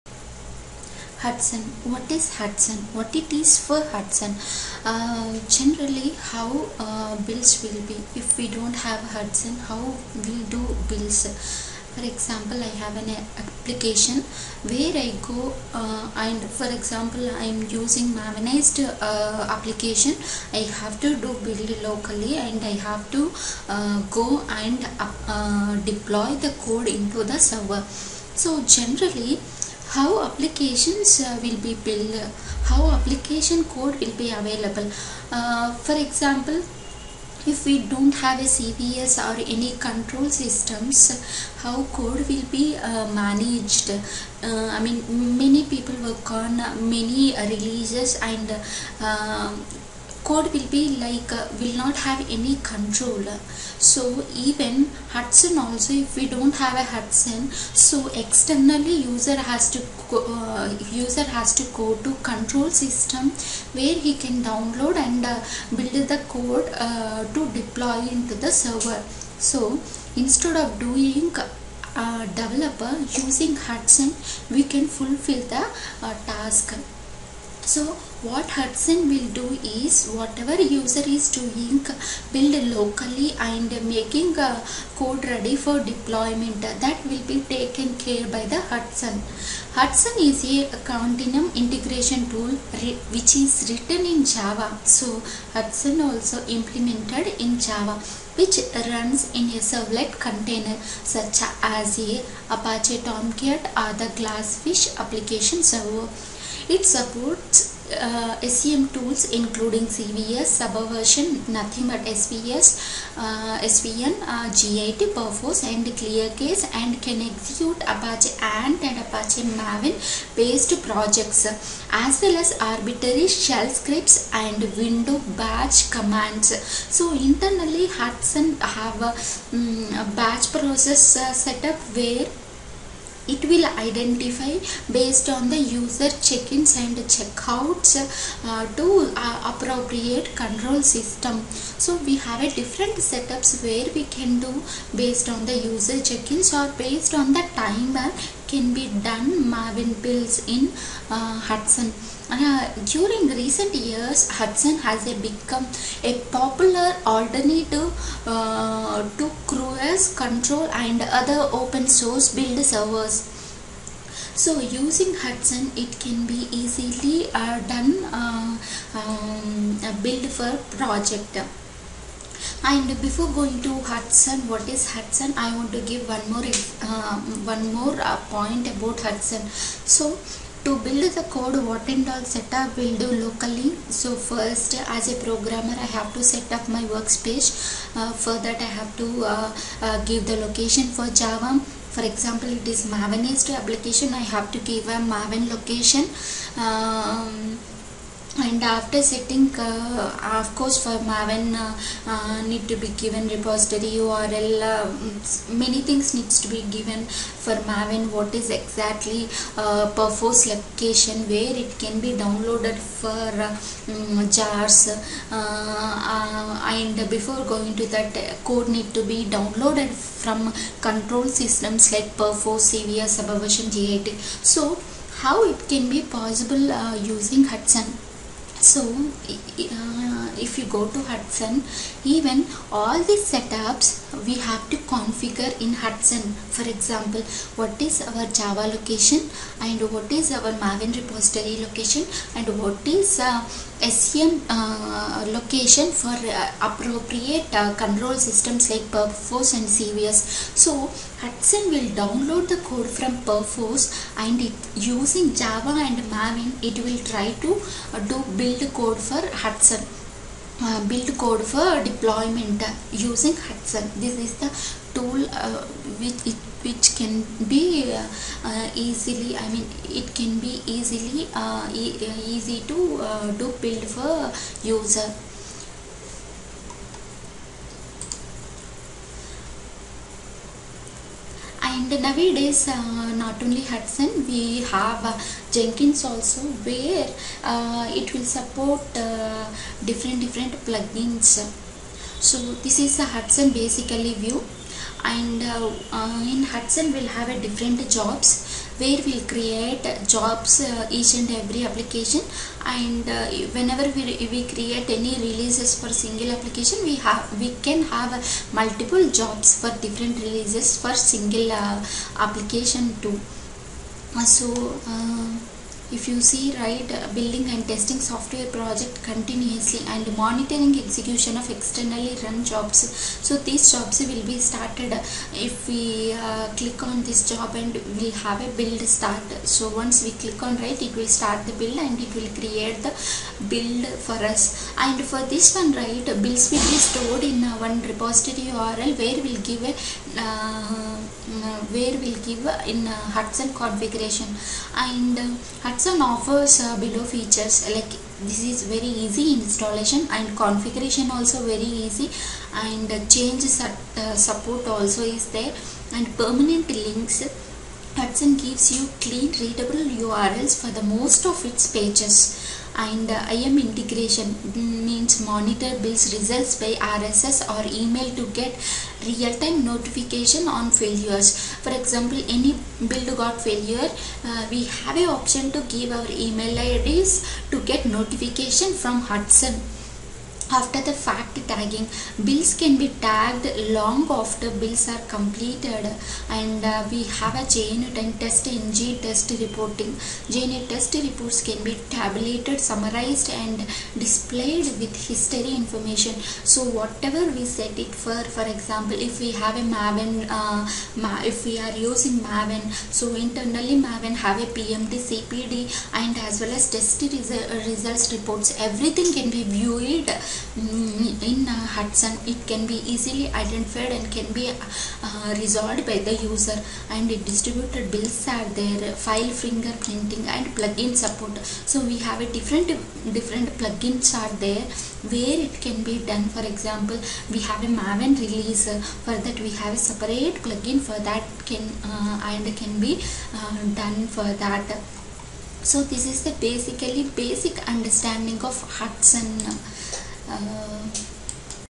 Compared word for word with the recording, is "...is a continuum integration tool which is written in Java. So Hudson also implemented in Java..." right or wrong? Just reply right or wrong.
right.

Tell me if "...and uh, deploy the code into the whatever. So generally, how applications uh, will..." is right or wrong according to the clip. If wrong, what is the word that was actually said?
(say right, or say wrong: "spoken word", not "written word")
wrong: "server", not "whatever".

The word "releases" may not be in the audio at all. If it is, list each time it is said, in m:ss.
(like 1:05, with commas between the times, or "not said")
0:47, 5:05, 5:10, 7:08.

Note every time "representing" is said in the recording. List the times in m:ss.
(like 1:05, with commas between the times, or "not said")
not said.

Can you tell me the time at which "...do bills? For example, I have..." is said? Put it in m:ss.
0:10.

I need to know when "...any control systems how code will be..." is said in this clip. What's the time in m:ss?
0:39.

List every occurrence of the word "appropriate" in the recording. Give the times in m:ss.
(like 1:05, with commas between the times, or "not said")
2:19, 4:06.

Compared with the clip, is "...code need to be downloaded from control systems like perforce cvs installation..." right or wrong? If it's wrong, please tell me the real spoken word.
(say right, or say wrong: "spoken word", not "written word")
wrong: "subversion", not "installation".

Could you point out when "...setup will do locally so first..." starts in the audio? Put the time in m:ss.
3:02.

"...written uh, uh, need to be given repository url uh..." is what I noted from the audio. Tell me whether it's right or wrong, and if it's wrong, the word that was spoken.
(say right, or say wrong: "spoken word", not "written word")
wrong: "maven", not "written".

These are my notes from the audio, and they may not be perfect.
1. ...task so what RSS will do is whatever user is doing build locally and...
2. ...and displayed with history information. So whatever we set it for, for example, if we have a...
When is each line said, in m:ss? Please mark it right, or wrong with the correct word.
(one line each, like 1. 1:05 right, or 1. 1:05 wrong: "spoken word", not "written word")
1. 1:16 wrong: "Hudson", not "RSS"
2. 6:33 right.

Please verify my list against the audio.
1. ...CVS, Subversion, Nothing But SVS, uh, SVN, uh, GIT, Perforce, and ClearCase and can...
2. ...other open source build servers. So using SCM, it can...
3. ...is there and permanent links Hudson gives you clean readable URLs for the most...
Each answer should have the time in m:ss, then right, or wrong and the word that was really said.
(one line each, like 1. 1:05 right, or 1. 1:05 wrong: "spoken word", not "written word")
1. 1:49 right
2. 2:41 wrong: "Hudson", not "SCM"
3. 5:55 right.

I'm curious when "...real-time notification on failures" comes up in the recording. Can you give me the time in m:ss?
6:09.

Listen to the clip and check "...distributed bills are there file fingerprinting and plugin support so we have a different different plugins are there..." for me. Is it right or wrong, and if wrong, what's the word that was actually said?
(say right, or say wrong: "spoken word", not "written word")
right.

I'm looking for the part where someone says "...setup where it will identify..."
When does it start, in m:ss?
2:11.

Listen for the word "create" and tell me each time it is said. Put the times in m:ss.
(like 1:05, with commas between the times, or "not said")
4:59, 5:04, 5:32.